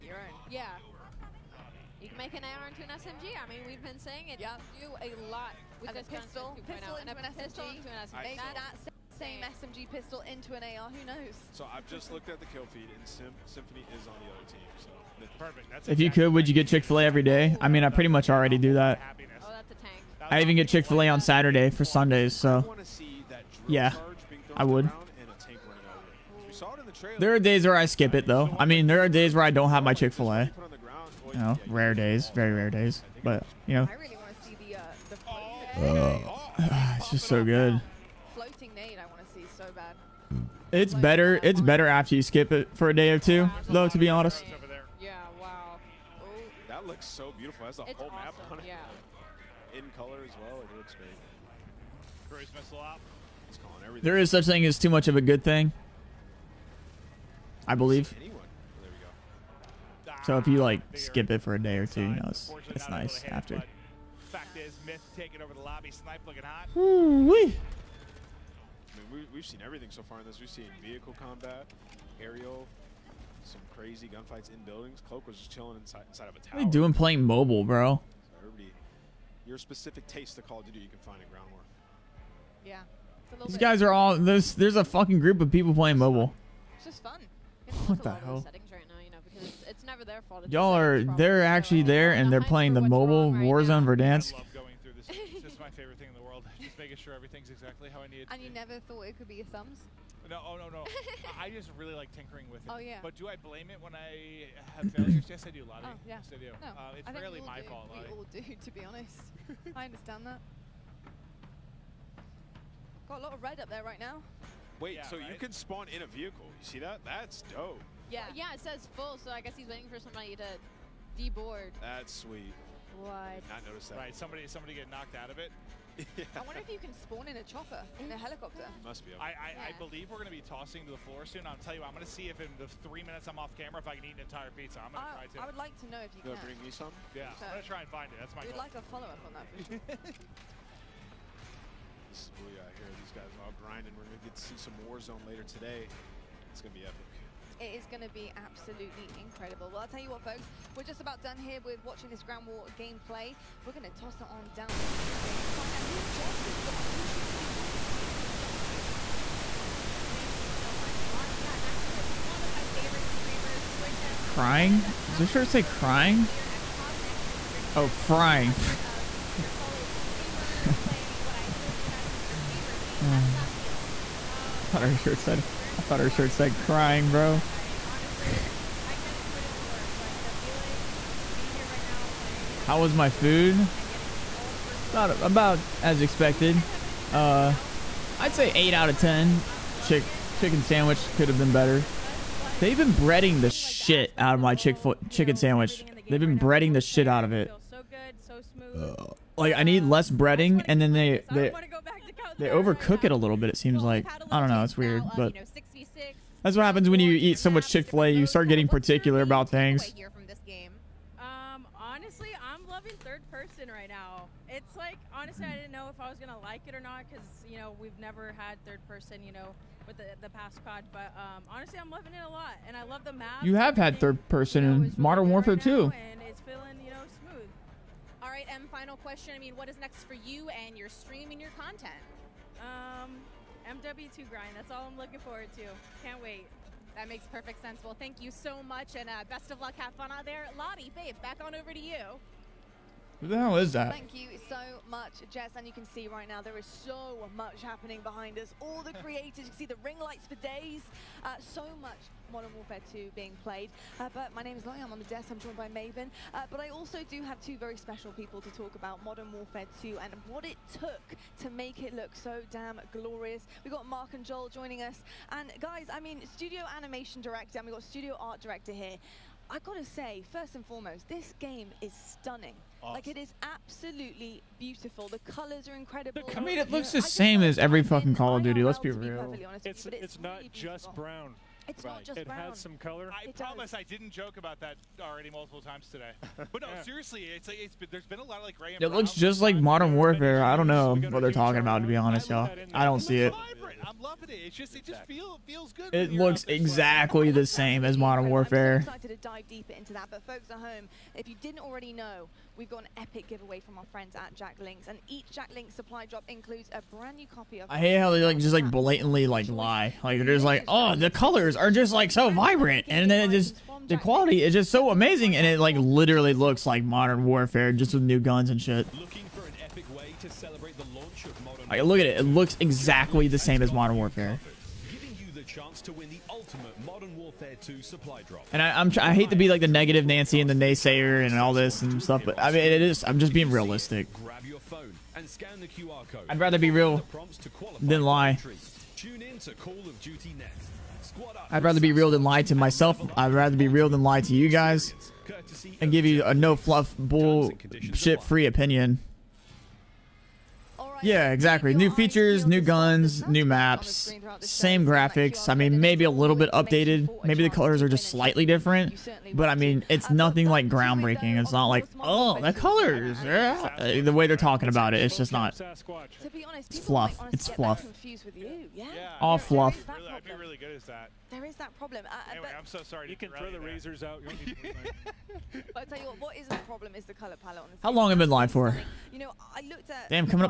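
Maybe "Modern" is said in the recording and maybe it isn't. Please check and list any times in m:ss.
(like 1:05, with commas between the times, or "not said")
3:44, 4:12, 4:19, 4:49, 4:57, 5:16, 5:23.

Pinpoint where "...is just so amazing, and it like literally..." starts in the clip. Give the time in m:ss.
5:14.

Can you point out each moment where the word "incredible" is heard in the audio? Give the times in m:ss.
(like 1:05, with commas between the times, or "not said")
2:29, 4:35.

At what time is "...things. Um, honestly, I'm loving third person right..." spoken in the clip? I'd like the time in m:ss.
3:29.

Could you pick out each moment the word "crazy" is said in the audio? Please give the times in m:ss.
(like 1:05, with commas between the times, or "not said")
1:13.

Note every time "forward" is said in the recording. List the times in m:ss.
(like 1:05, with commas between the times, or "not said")
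3:55.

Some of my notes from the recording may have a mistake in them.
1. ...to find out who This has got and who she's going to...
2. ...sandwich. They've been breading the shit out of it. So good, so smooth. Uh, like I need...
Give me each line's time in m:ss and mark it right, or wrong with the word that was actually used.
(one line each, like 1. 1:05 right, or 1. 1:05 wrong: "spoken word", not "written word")
1. 2:35 wrong: "Jess", not "This"
2. 3:15 right.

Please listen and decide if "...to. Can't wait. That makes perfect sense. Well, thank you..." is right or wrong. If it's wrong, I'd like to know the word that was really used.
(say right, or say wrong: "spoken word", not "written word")
right.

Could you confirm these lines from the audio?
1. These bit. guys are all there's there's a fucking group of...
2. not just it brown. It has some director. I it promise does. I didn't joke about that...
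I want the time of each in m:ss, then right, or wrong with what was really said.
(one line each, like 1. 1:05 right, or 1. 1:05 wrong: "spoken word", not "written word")
1. 1:23 right
2. 4:41 wrong: "color", not "director".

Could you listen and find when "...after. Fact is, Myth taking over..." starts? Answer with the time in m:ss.
1:03.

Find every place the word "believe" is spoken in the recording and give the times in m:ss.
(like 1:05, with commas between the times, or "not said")
0:57, 2:09.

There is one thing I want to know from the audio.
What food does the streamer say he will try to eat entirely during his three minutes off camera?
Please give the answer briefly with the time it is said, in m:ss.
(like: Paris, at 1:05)
An entire pizza, at 2:14.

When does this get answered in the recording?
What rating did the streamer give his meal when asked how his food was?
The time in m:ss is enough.
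3:08.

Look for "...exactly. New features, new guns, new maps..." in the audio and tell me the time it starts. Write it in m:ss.
5:51.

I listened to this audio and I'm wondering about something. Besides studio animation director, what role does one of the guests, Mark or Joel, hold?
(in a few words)
Studio art director.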